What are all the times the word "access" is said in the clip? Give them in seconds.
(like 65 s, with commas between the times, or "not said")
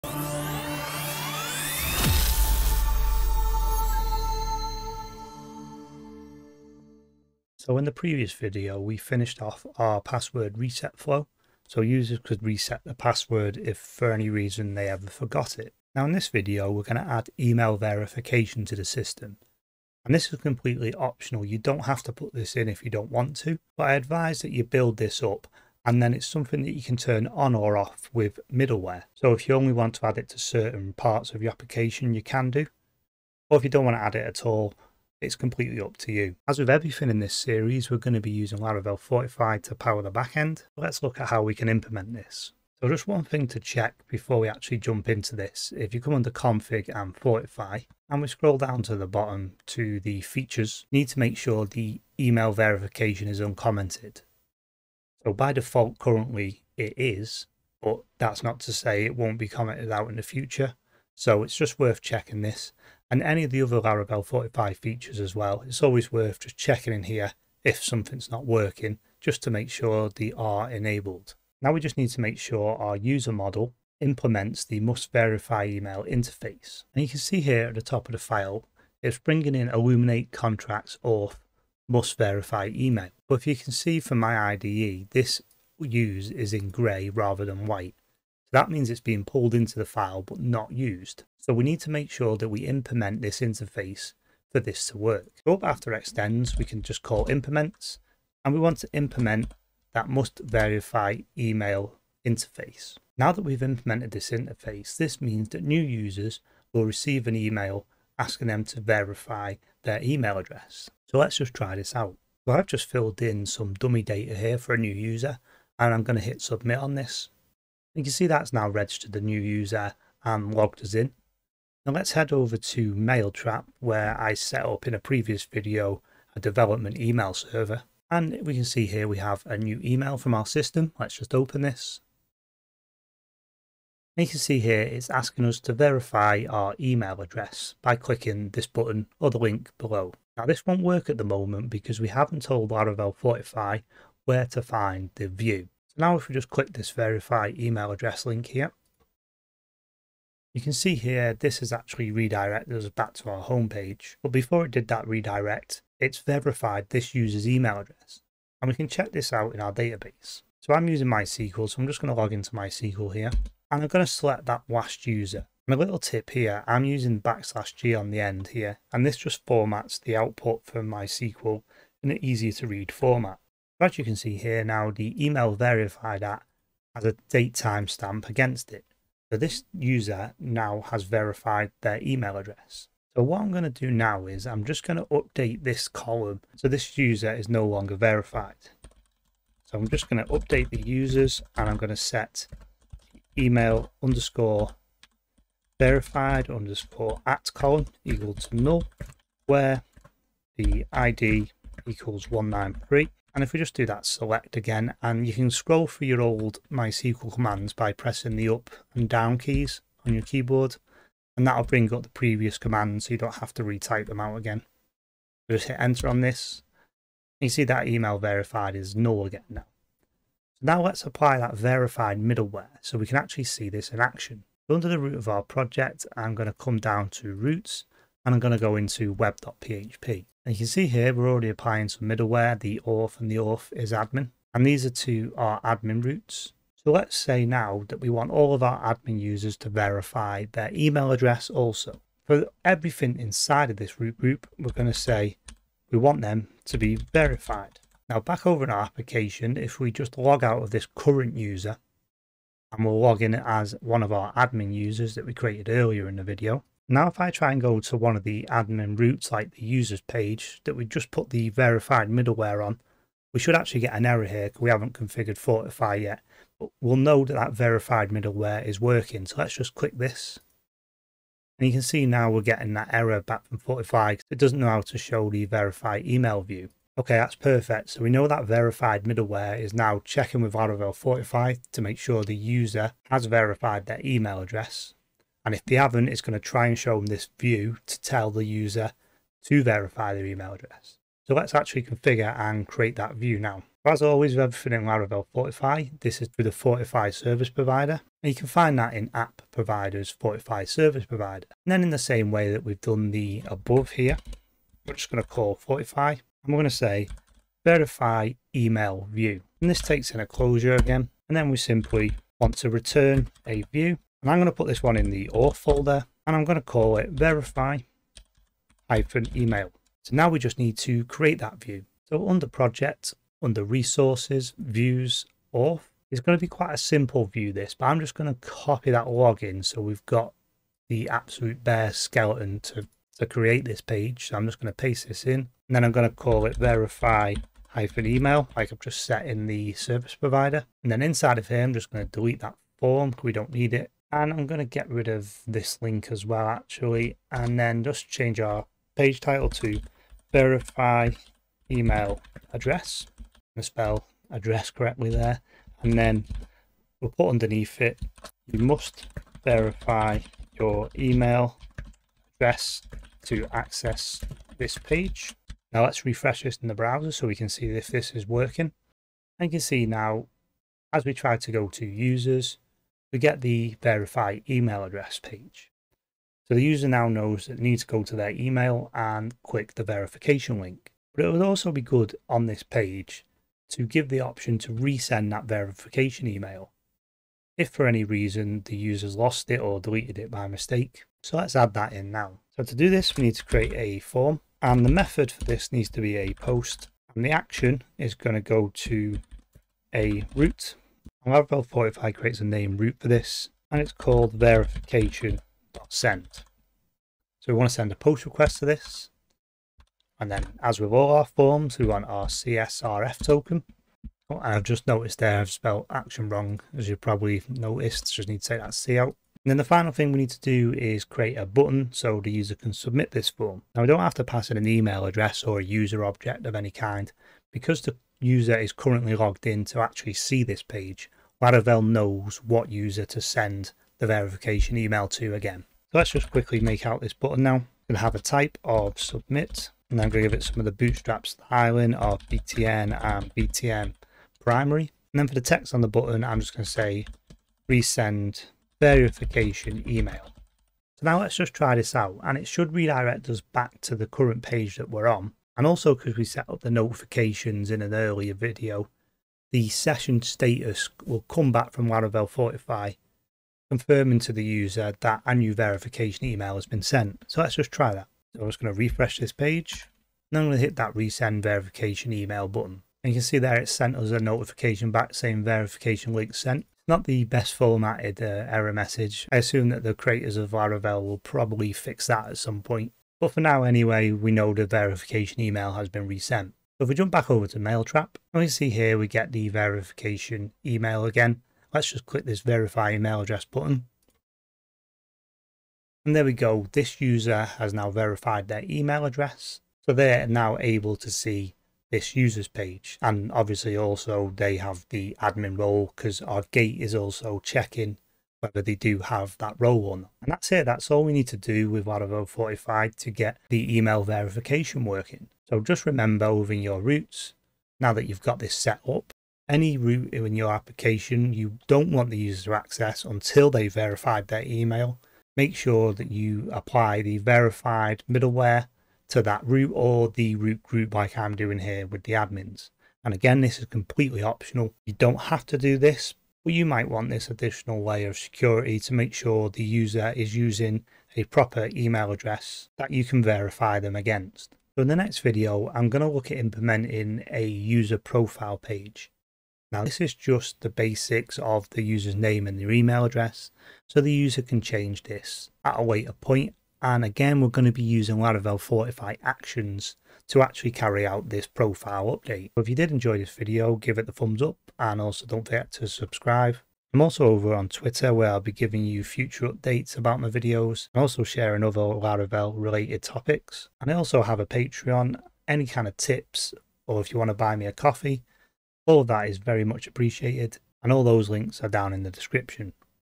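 363 s, 522 s.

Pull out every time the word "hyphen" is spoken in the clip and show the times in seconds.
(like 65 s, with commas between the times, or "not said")
318 s, 337 s.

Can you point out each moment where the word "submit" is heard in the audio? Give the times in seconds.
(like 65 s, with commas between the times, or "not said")
116 s, 422 s, 438 s.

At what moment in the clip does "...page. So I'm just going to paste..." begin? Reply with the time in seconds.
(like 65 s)
333 s.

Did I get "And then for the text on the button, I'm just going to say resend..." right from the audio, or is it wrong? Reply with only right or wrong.
right.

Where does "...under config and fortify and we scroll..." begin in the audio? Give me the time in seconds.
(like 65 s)
46 s.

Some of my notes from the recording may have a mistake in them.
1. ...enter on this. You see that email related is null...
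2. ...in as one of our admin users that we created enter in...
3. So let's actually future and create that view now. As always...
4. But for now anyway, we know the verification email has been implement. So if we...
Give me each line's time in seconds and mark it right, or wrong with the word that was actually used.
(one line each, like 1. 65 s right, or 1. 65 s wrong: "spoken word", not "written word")
1. 215 s wrong: "verified", not "related"
2. 253 s wrong: "earlier", not "enter"
3. 291 s wrong: "configure", not "future"
4. 483 s wrong: "resent", not "implement".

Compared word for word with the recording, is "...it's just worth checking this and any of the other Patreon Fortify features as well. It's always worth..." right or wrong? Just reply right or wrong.
wrong.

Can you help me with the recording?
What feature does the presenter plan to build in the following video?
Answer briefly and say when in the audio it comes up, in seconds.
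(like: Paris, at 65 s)
user profile page, at 547 s.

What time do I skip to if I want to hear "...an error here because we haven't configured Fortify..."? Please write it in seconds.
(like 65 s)
263 s.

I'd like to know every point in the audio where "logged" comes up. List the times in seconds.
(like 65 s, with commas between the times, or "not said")
120 s, 429 s.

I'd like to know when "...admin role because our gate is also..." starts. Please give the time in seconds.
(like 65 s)
505 s.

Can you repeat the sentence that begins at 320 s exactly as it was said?
So now we just need to create that view.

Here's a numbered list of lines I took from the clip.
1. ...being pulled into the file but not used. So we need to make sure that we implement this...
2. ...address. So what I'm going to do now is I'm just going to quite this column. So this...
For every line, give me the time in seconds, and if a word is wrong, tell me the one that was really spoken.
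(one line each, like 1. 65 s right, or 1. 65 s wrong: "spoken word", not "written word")
1. 88 s right
2. 182 s wrong: "update", not "quite".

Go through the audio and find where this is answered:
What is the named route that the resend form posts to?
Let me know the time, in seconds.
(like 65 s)
404 s.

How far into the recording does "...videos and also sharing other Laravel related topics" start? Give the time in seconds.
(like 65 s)
570 s.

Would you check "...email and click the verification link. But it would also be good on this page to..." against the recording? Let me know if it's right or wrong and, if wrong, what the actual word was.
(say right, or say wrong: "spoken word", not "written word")
right.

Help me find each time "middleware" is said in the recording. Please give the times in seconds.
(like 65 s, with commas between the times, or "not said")
28 s, 222 s, 232 s, 262 s, 268 s, 279 s, 528 s.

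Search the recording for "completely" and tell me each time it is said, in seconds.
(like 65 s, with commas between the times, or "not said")
20 s, 35 s, 533 s.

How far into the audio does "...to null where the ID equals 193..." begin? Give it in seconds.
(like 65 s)
198 s.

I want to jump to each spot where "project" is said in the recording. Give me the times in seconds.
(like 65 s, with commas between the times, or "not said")
225 s, 322 s.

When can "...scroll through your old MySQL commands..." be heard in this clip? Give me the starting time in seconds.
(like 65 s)
205 s.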